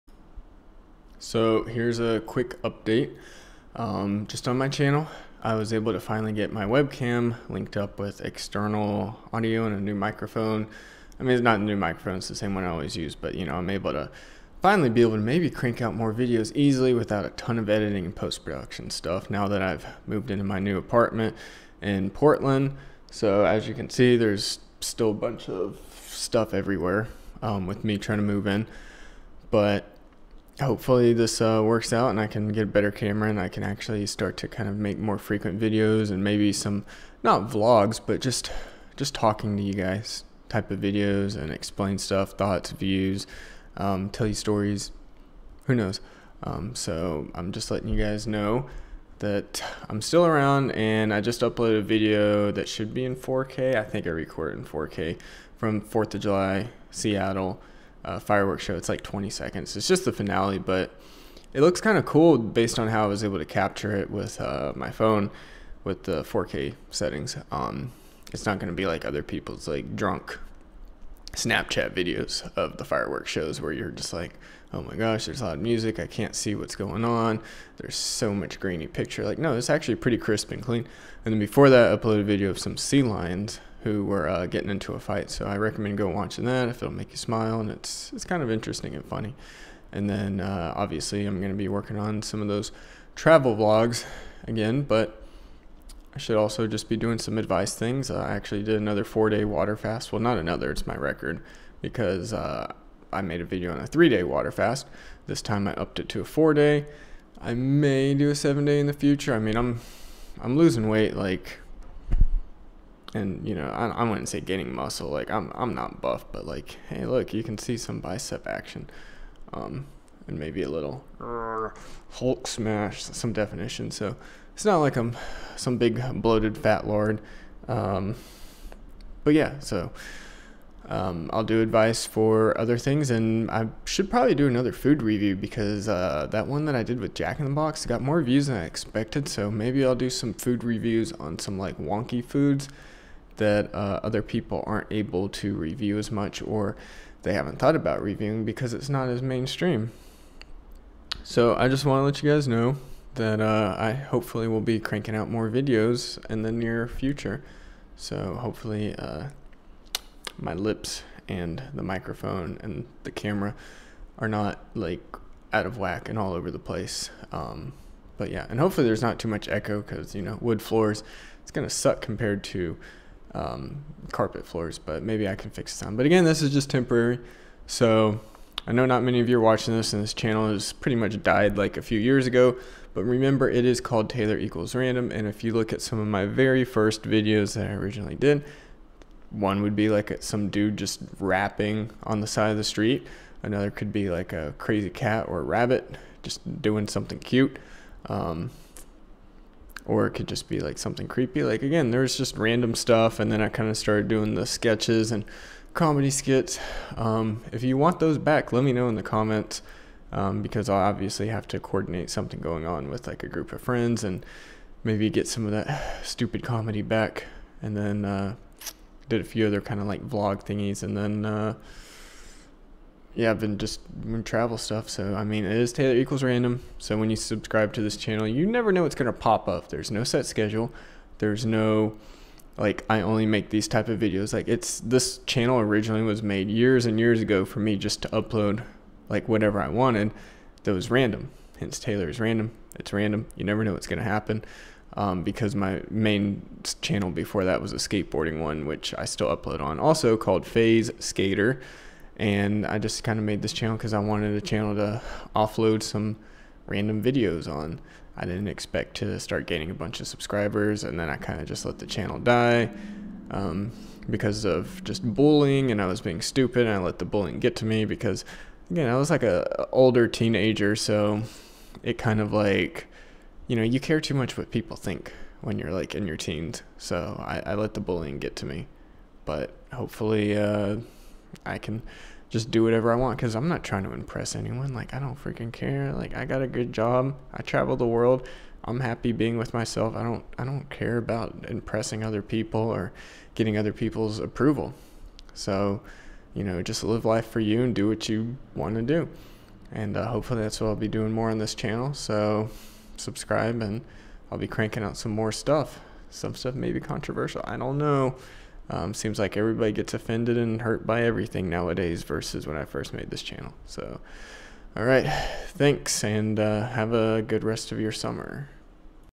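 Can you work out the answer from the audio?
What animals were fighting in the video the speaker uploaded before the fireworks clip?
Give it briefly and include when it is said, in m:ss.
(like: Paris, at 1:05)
Sea lions, at 1:22.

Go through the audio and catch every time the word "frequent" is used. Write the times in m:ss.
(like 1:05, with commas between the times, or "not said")
0:35.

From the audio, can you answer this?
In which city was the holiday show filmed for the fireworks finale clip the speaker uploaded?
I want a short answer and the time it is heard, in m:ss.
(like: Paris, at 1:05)
Seattle, at 0:56.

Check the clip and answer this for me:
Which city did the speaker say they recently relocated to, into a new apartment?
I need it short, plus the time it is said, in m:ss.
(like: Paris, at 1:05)
Portland, at 0:22.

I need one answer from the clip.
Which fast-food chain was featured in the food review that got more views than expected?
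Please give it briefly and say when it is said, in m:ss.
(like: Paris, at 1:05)
Jack in the Box, at 2:17.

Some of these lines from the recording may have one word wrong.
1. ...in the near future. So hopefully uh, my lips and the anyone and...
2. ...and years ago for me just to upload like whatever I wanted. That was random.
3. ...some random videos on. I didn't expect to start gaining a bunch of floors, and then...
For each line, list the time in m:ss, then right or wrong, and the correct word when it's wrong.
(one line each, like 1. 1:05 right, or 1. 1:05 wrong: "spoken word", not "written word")
1. 2:36 wrong: "microphone", not "anyone"
2. 3:56 right
3. 4:15 wrong: "subscribers", not "floors".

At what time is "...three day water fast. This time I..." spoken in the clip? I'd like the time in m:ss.
1:43.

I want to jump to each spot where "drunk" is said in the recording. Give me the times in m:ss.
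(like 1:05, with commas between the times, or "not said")
1:09.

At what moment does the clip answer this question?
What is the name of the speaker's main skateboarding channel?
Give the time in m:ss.
4:10.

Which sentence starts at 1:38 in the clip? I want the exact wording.
Uh, I actually did another four day water fast.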